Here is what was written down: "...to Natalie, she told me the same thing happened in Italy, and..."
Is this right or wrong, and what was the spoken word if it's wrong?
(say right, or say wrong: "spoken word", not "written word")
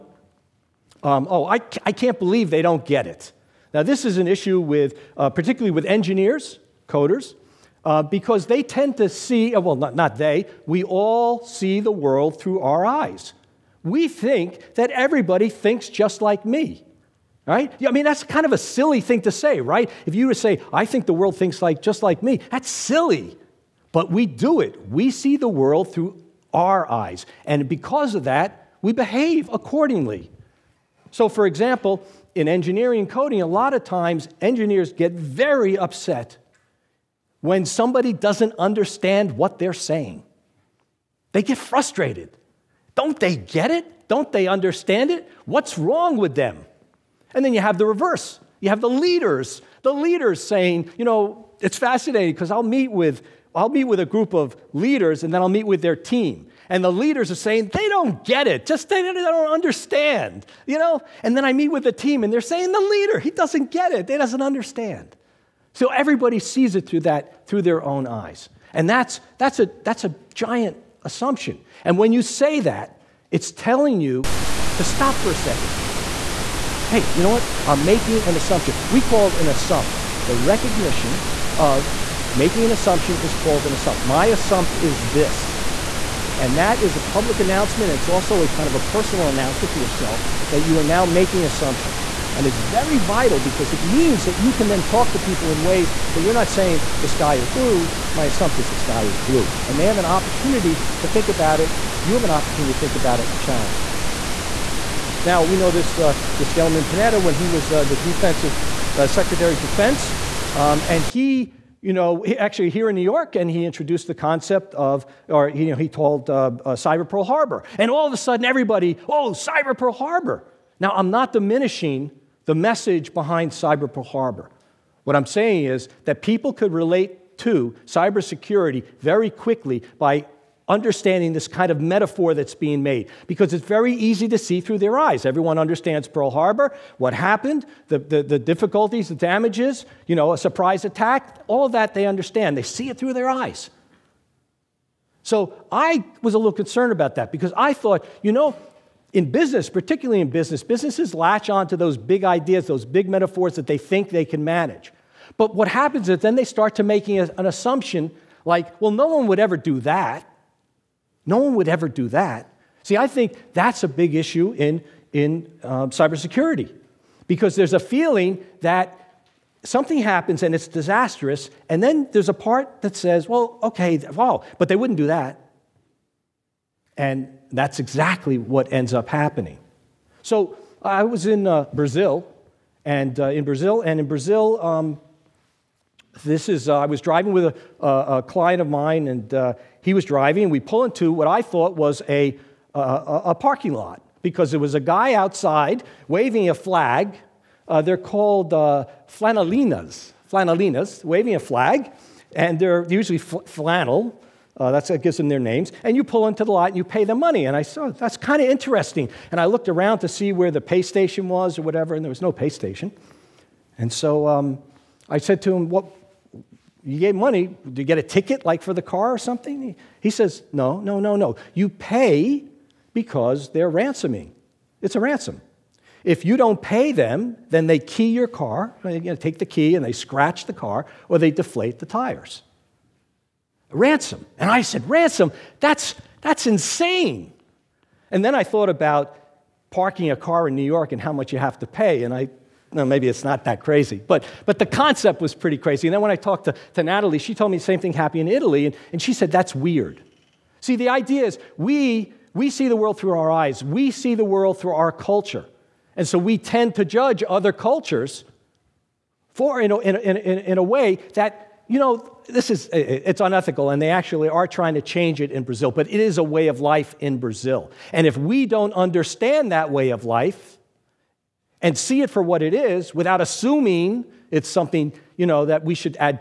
right.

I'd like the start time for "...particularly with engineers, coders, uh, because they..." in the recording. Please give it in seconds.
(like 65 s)
5 s.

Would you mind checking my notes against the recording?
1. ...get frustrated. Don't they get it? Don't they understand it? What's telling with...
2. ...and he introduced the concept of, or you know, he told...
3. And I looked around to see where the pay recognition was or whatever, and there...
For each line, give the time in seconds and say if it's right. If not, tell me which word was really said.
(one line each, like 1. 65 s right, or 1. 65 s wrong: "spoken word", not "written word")
1. 41 s wrong: "wrong", not "telling"
2. 113 s right
3. 209 s wrong: "station", not "recognition".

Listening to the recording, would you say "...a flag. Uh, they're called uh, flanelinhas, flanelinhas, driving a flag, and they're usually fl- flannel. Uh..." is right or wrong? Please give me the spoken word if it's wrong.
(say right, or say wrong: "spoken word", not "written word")
wrong: "waving", not "driving".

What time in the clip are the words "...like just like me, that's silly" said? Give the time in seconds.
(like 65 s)
21 s.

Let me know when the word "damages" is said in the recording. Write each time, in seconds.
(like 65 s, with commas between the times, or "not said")
139 s.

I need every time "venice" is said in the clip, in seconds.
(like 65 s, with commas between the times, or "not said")
not said.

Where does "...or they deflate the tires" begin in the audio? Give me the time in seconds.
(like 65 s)
231 s.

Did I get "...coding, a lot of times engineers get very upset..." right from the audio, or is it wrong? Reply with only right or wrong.
right.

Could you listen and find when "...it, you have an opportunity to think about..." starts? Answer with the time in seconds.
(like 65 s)
101 s.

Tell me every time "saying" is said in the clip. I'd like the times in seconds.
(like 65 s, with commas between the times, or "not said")
39 s, 50 s, 57 s, 62 s, 96 s, 125 s.